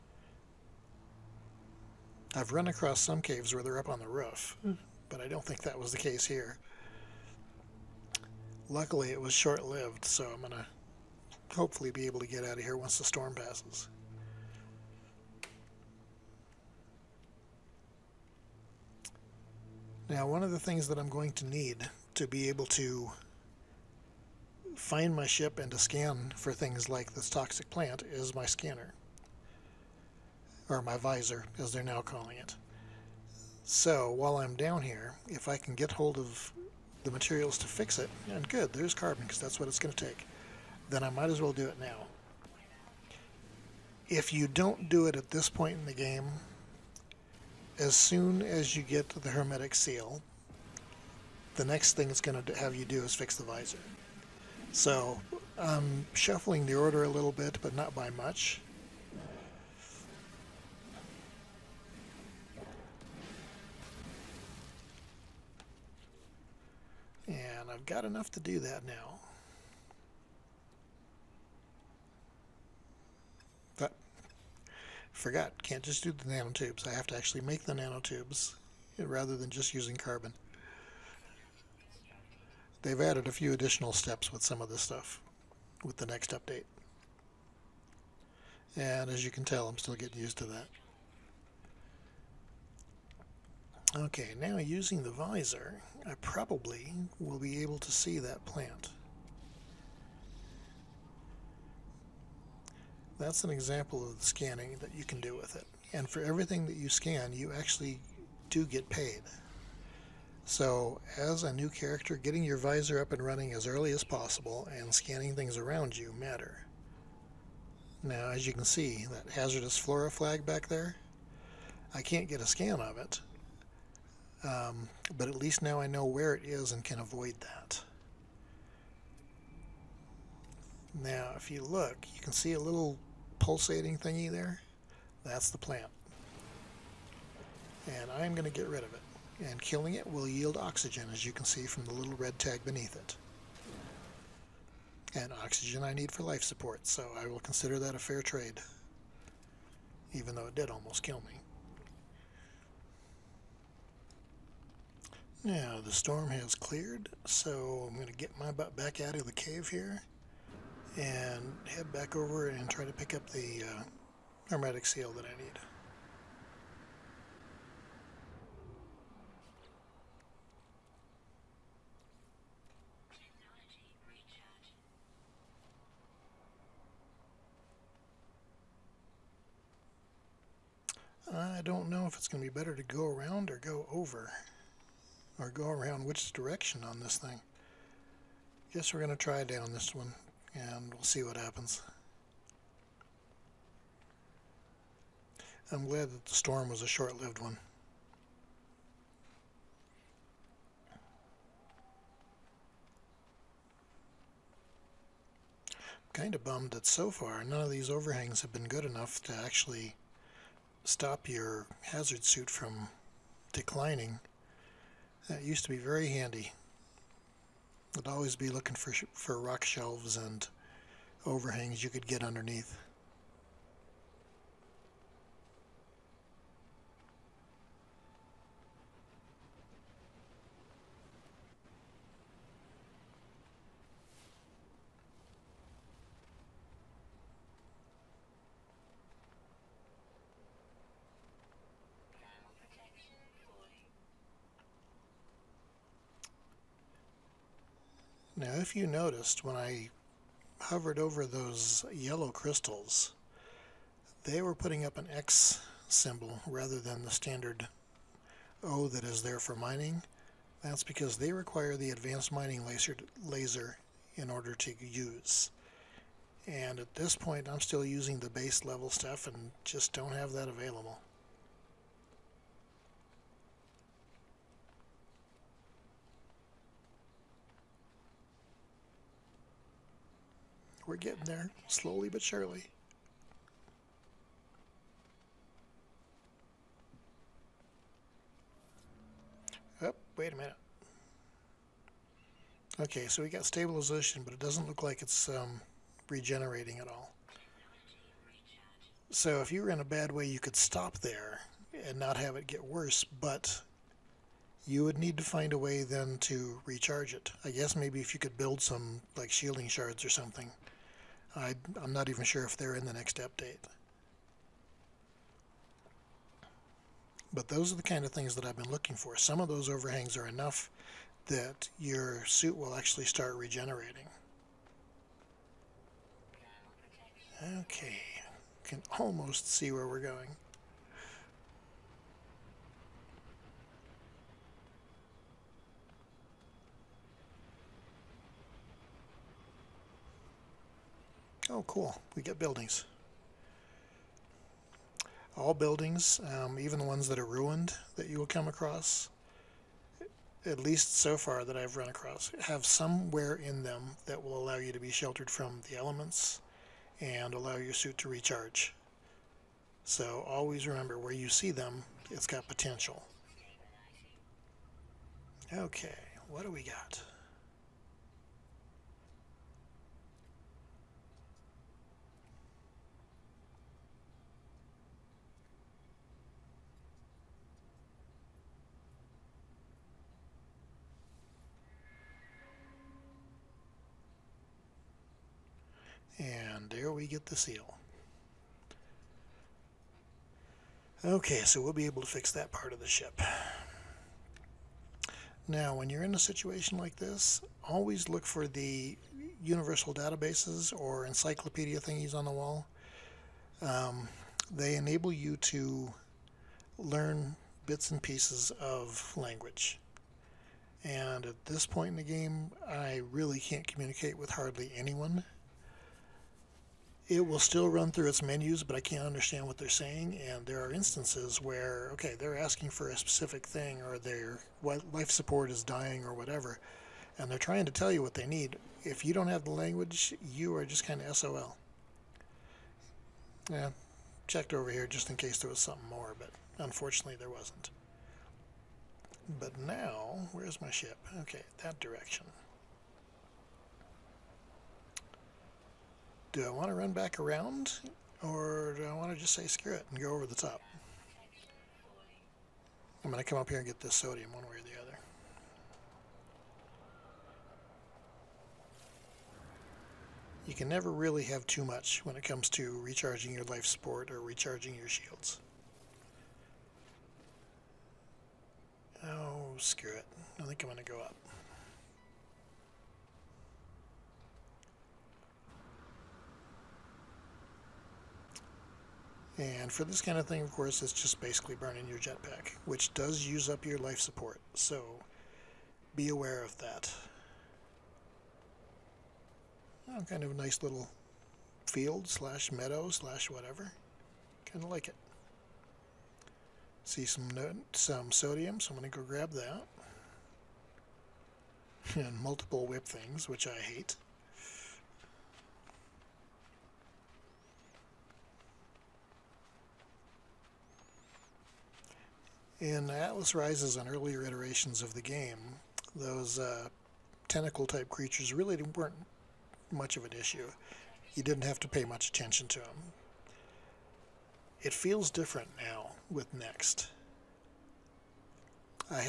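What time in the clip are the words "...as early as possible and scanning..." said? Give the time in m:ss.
1:53.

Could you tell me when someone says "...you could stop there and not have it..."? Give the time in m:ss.
5:00.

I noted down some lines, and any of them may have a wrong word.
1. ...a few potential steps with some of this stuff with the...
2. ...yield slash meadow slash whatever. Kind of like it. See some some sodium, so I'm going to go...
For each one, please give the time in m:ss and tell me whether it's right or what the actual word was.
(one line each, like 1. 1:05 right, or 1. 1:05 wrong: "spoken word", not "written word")
1. 1:23 wrong: "additional", not "potential"
2. 8:11 wrong: "field", not "yield".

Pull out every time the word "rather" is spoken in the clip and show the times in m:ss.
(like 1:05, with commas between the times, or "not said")
1:18, 4:16.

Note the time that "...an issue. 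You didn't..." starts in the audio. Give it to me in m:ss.
8:40.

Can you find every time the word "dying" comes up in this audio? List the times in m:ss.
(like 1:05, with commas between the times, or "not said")
7:05.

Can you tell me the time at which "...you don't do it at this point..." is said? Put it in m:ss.
0:44.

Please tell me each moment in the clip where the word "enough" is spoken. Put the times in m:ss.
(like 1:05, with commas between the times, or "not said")
1:08, 3:28, 5:20.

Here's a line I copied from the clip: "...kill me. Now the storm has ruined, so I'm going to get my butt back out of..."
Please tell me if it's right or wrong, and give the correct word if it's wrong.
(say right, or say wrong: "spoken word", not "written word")
wrong: "cleared", not "ruined".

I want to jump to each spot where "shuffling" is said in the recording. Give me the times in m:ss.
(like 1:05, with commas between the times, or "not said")
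0:56.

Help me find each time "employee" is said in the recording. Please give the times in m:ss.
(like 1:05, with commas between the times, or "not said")
not said.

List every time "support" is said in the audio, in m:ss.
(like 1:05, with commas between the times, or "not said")
2:26, 7:05, 7:43, 8:03.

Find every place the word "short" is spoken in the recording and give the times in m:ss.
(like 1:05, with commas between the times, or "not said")
0:09, 3:16.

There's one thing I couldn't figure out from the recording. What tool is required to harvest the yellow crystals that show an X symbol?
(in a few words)
Advanced mining laser.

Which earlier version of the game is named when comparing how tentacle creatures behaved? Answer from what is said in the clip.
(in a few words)
Atlas Rises.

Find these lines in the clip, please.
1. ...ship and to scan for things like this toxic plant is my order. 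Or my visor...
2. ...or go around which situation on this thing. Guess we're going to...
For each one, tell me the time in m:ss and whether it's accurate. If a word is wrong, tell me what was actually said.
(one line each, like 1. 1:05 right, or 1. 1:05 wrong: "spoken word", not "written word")
1. 0:25 wrong: "scanner", not "order"
2. 3:05 wrong: "direction", not "situation".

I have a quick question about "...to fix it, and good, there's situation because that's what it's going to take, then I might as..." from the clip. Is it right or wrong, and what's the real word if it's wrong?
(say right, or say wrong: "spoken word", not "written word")
wrong: "carbon", not "situation".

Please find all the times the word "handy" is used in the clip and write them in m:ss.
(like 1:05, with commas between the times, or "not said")
3:36.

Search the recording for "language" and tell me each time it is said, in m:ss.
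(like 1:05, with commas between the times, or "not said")
6:49, 7:09.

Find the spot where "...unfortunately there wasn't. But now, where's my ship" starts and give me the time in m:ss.
7:16.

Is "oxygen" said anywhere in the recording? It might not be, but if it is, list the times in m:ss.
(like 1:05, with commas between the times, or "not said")
2:20, 2:25.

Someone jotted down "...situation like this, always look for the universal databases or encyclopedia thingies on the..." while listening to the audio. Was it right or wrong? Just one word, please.
right.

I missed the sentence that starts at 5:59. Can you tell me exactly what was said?
So always remember where you see them, it's got potential.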